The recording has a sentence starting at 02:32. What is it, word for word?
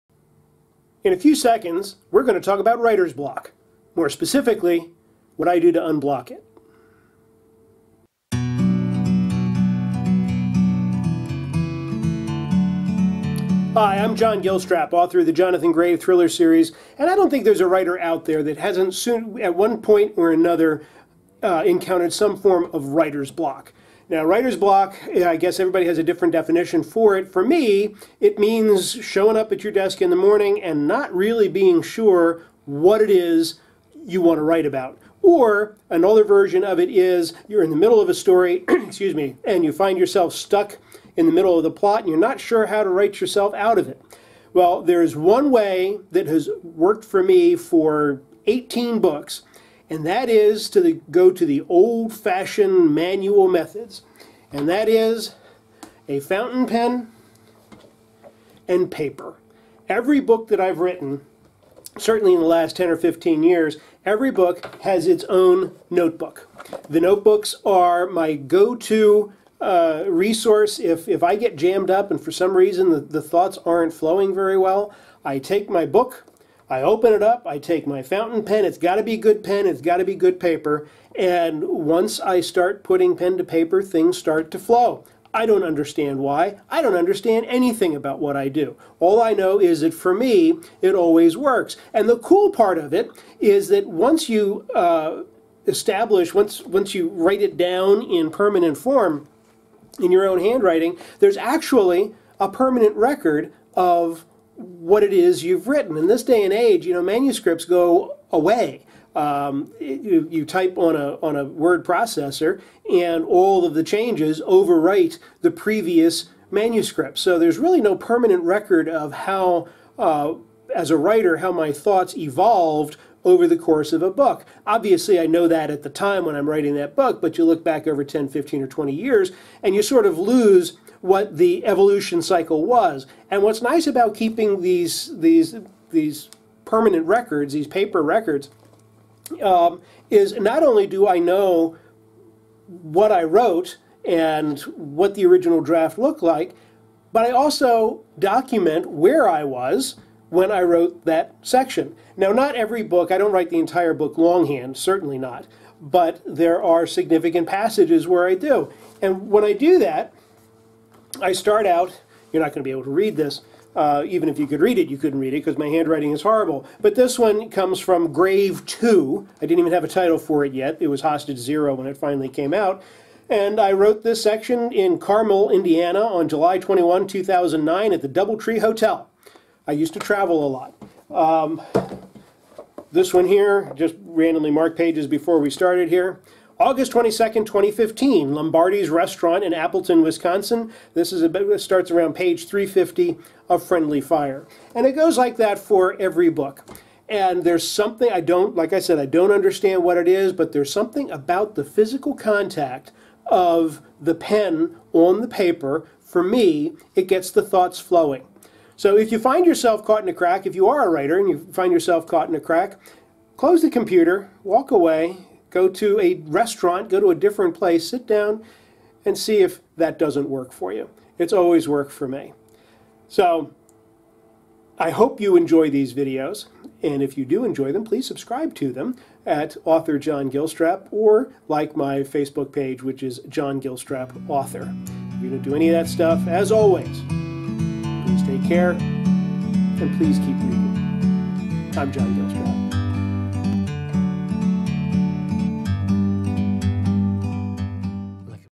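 Now, not every book, I don't write the entire book longhand, certainly not, but there are significant passages where I do.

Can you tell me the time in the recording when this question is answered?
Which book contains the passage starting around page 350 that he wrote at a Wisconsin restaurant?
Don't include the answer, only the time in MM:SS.
03:13.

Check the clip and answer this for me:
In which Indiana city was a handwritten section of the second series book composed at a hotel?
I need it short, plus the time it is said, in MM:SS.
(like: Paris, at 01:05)
Carmel, at 02:54.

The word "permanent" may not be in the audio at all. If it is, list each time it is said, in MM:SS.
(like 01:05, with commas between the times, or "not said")
01:38, 01:42, 01:57, 02:16.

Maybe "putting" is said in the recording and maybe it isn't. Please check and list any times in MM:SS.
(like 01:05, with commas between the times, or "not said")
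01:22.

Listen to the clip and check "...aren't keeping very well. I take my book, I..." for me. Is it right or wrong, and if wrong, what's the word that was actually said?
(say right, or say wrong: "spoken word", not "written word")
wrong: "flowing", not "keeping".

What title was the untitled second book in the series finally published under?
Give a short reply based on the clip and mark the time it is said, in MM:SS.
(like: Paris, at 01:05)
Hostage Zero, at 02:51.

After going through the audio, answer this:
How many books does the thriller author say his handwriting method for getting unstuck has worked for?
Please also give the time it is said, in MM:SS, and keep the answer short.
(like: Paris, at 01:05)
18, at 00:48.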